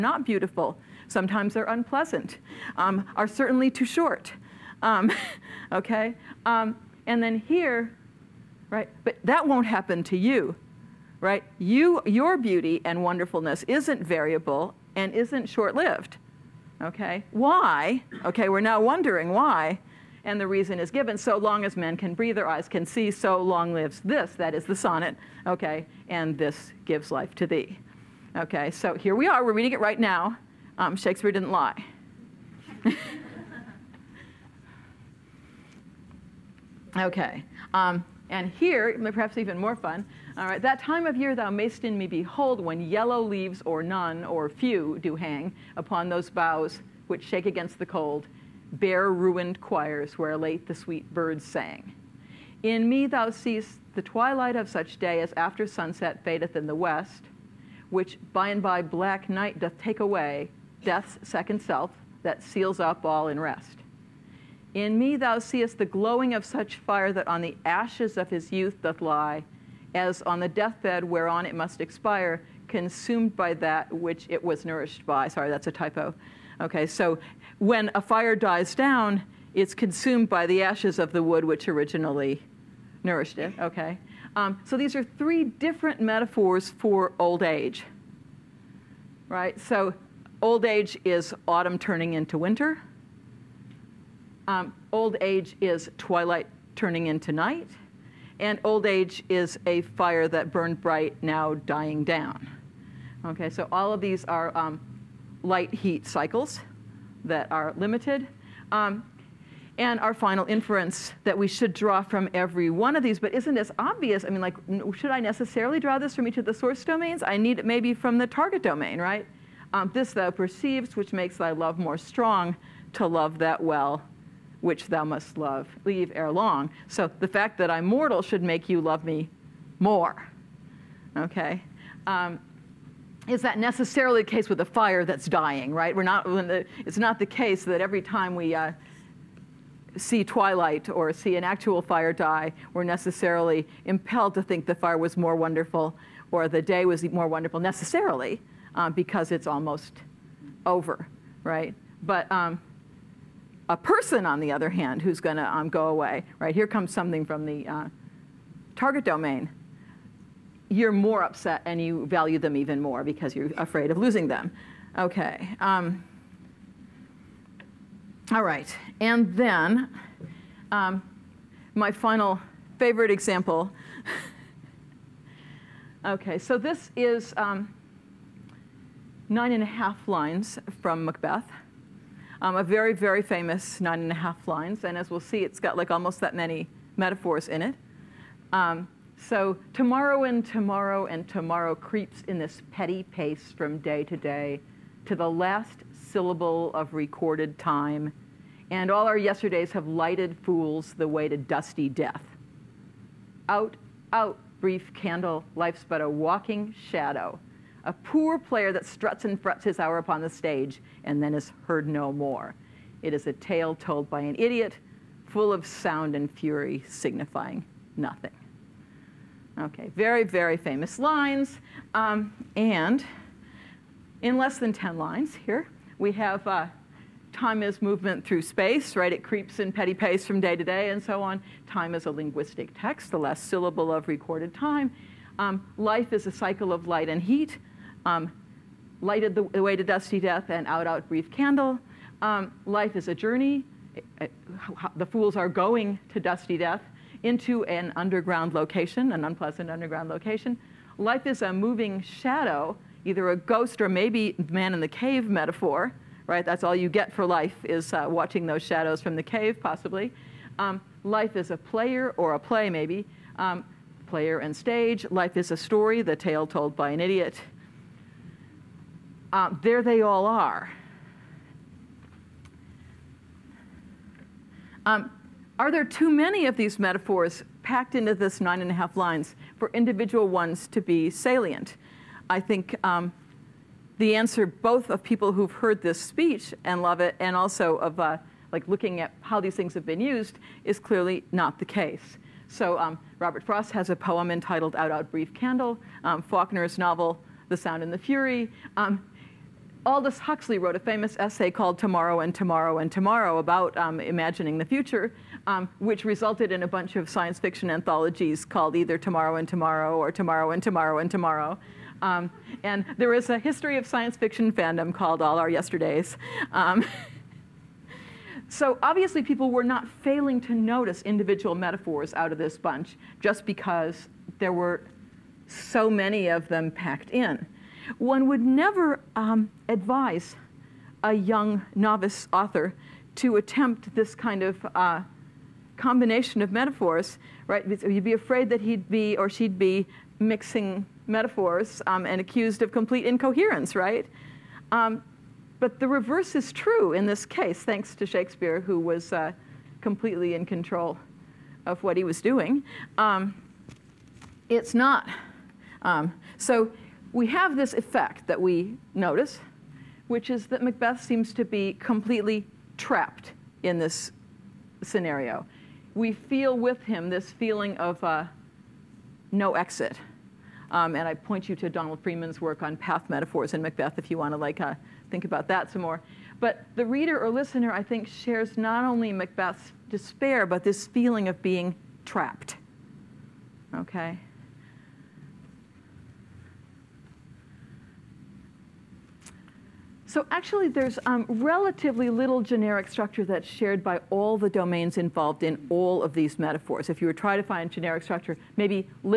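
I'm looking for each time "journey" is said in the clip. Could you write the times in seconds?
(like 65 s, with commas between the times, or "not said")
243 s.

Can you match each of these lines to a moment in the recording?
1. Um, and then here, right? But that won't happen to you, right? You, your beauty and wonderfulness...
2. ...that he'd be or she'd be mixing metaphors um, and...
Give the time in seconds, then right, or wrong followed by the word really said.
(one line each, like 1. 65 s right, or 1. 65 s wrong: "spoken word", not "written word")
1. 6 s right
2. 338 s right.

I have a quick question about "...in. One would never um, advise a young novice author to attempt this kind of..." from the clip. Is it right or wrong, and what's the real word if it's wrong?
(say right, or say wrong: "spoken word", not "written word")
right.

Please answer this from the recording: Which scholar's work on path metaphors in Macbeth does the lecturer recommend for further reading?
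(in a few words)
Donald Freeman.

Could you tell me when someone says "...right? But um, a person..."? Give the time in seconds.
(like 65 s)
151 s.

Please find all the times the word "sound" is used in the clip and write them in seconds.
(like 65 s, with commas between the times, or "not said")
215 s, 297 s.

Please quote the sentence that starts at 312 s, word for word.
Um, and there is a history of science fiction fandom called All Our Yesterdays.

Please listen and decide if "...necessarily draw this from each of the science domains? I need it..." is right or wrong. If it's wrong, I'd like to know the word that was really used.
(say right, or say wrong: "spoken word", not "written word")
wrong: "source", not "science".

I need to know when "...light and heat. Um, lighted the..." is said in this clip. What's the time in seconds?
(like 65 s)
236 s.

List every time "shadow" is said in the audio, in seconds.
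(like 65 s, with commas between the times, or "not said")
206 s, 252 s, 258 s.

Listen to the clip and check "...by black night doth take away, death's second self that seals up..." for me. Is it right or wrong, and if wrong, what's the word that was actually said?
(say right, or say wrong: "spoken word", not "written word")
right.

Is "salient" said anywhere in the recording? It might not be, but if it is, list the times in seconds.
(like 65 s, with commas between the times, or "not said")
281 s.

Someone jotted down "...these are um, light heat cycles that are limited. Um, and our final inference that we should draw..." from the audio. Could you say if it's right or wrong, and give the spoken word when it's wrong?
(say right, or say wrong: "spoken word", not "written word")
right.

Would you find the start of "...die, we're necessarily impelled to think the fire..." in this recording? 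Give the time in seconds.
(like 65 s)
142 s.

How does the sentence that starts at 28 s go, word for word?
Okay, so here we are, we're reading it right now.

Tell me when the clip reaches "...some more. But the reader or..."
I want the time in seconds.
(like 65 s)
375 s.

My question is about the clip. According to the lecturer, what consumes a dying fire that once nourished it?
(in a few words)
The ashes of the wood.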